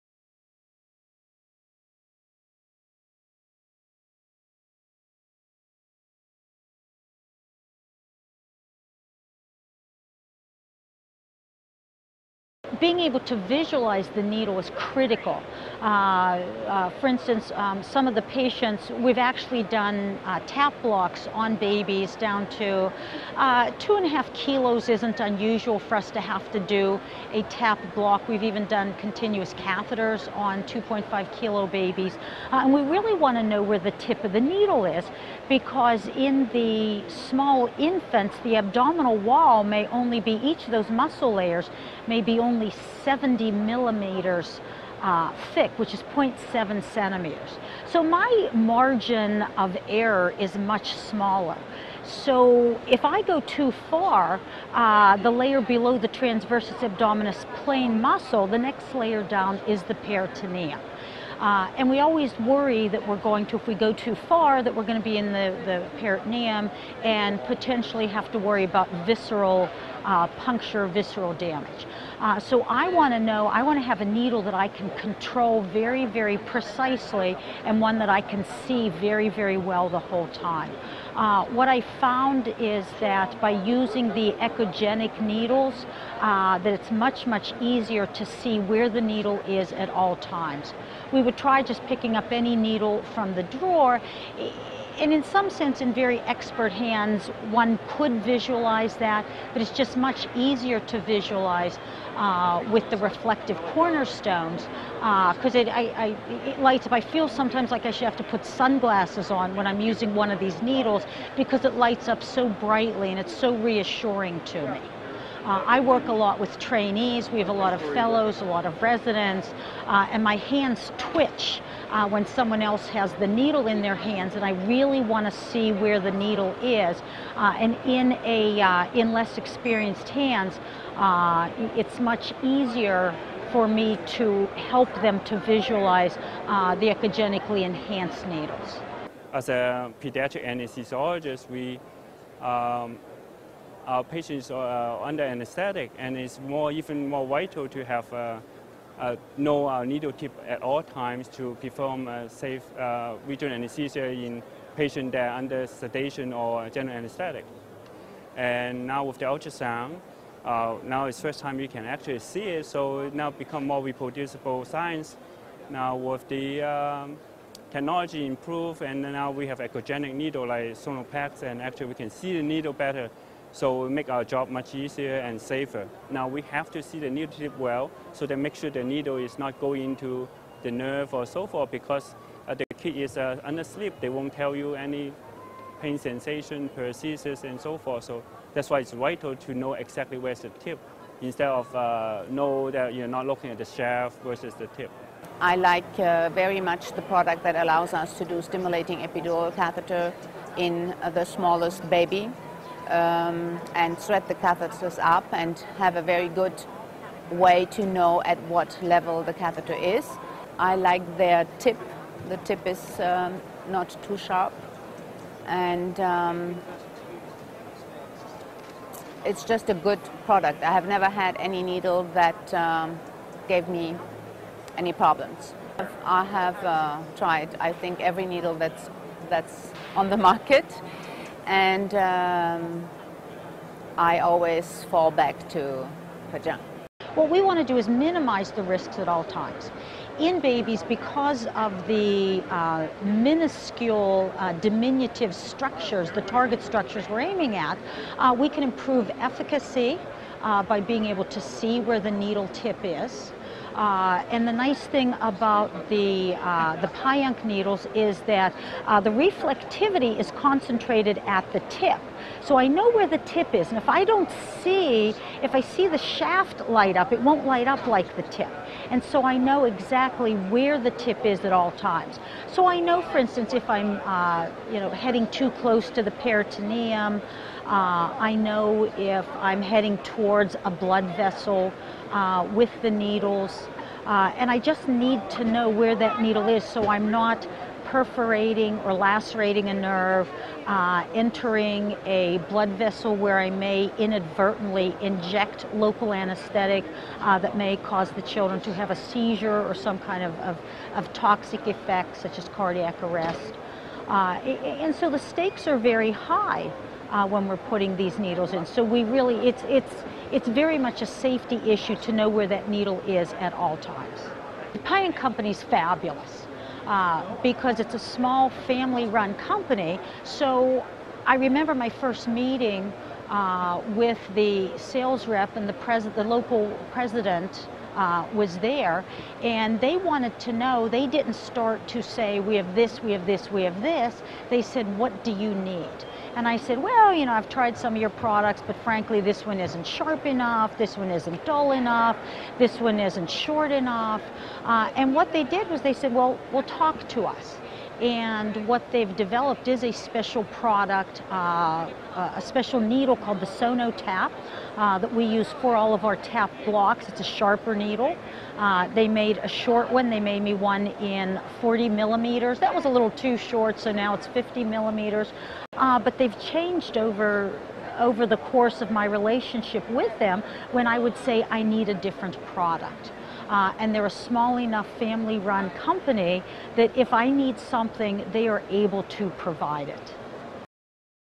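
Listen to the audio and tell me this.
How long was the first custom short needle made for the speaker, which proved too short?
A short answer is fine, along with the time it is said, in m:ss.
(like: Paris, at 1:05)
40 millimeters, at 6:01.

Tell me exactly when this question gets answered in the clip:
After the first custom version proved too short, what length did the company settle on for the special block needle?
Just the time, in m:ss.
6:04.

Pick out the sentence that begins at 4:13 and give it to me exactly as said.
Uh, and the nice thing about the, uh, the Pajunk needles is that uh, the reflectivity is concentrated at the tip.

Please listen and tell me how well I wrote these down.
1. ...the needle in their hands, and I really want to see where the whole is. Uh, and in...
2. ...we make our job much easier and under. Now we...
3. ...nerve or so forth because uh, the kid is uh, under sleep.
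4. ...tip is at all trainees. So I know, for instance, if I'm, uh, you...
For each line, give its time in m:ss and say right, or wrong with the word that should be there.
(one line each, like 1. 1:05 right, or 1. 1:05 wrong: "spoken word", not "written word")
1. 2:03 wrong: "needle", not "whole"
2. 2:53 wrong: "safer", not "under"
3. 3:00 right
4. 4:30 wrong: "times", not "trainees".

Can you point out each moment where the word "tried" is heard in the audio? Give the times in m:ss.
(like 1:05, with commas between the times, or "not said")
3:47, 5:37.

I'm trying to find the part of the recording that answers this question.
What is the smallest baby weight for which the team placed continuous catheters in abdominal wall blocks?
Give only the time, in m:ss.
0:30.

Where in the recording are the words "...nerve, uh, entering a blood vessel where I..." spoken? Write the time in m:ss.
4:49.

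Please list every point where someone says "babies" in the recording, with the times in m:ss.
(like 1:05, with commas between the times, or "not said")
0:21, 0:31, 4:00.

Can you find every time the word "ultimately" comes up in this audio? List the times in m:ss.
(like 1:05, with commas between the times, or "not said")
not said.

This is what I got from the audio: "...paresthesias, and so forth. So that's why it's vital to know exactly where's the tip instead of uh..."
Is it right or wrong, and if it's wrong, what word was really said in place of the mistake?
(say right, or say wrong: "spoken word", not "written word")
right.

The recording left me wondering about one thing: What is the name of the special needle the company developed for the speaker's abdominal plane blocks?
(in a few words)
SonoTAP.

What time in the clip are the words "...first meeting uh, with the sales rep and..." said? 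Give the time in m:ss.
5:21.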